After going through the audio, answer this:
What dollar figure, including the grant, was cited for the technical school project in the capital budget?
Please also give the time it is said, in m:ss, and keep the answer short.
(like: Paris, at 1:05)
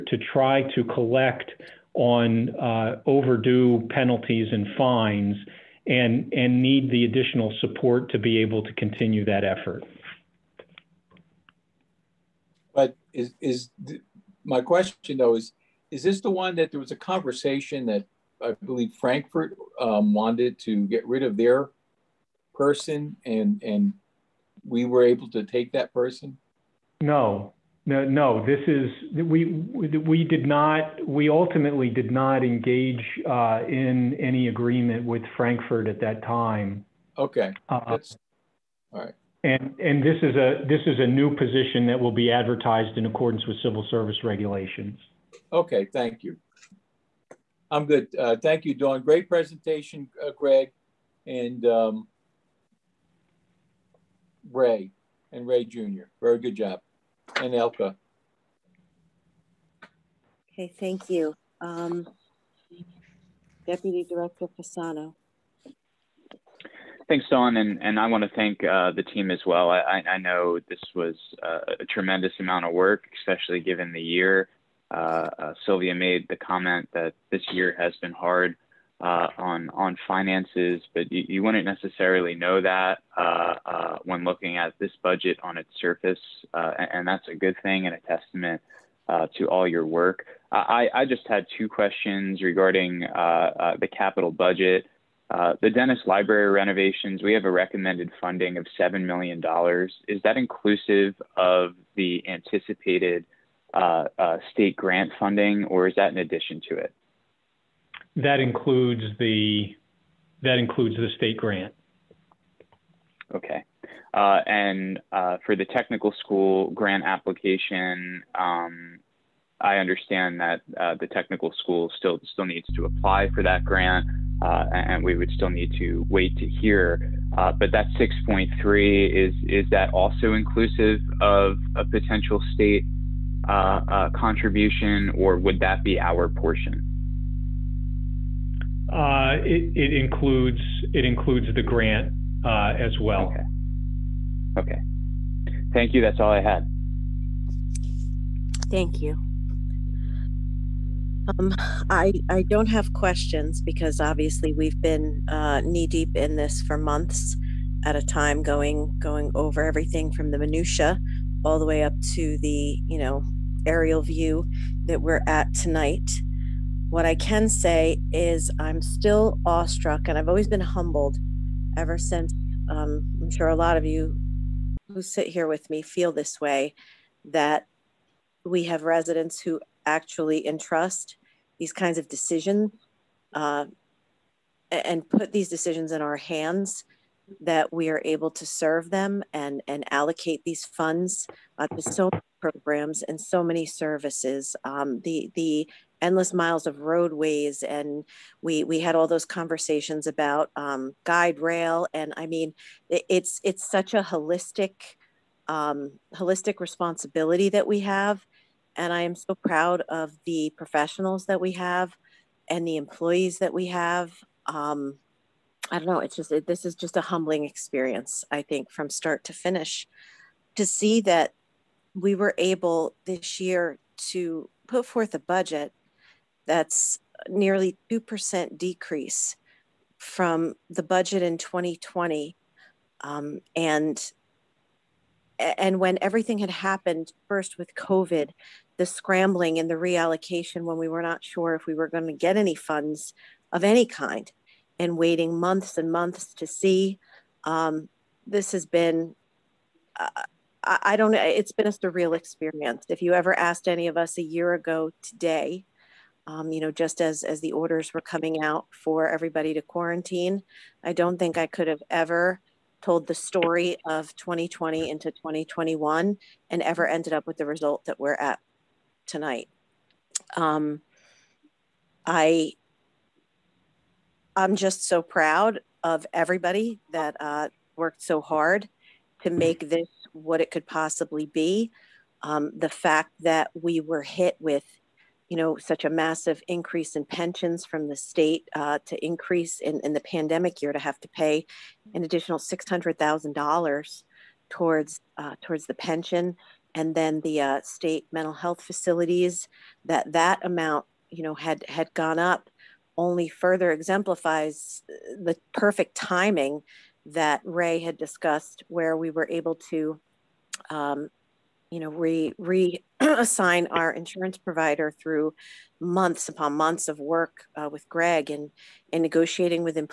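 6.3, at 2:07.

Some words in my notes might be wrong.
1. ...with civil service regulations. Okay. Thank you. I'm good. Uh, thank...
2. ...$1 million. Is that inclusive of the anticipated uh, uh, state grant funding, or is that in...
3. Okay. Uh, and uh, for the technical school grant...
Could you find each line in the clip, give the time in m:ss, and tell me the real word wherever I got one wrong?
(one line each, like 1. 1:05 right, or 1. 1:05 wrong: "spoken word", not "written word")
1. 0:43 right
2. 1:38 wrong: "7", not "1"
3. 1:53 right.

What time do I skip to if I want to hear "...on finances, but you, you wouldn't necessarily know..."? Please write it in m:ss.
1:19.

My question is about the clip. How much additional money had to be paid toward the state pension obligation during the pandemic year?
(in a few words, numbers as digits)
$600,000.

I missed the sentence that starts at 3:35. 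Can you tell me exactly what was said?
It's just it, this is just a humbling experience.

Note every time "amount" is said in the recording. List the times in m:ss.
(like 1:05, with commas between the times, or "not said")
1:12, 5:00.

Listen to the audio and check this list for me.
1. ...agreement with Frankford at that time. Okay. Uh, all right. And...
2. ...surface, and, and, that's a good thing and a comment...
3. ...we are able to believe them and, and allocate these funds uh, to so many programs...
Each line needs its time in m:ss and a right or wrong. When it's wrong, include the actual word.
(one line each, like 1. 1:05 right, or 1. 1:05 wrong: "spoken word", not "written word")
1. 0:34 right
2. 1:25 wrong: "testament", not "comment"
3. 3:07 wrong: "serve", not "believe".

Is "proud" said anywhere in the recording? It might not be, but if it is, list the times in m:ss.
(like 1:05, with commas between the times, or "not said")
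3:29, 4:35.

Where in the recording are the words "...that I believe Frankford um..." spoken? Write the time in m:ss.
0:17.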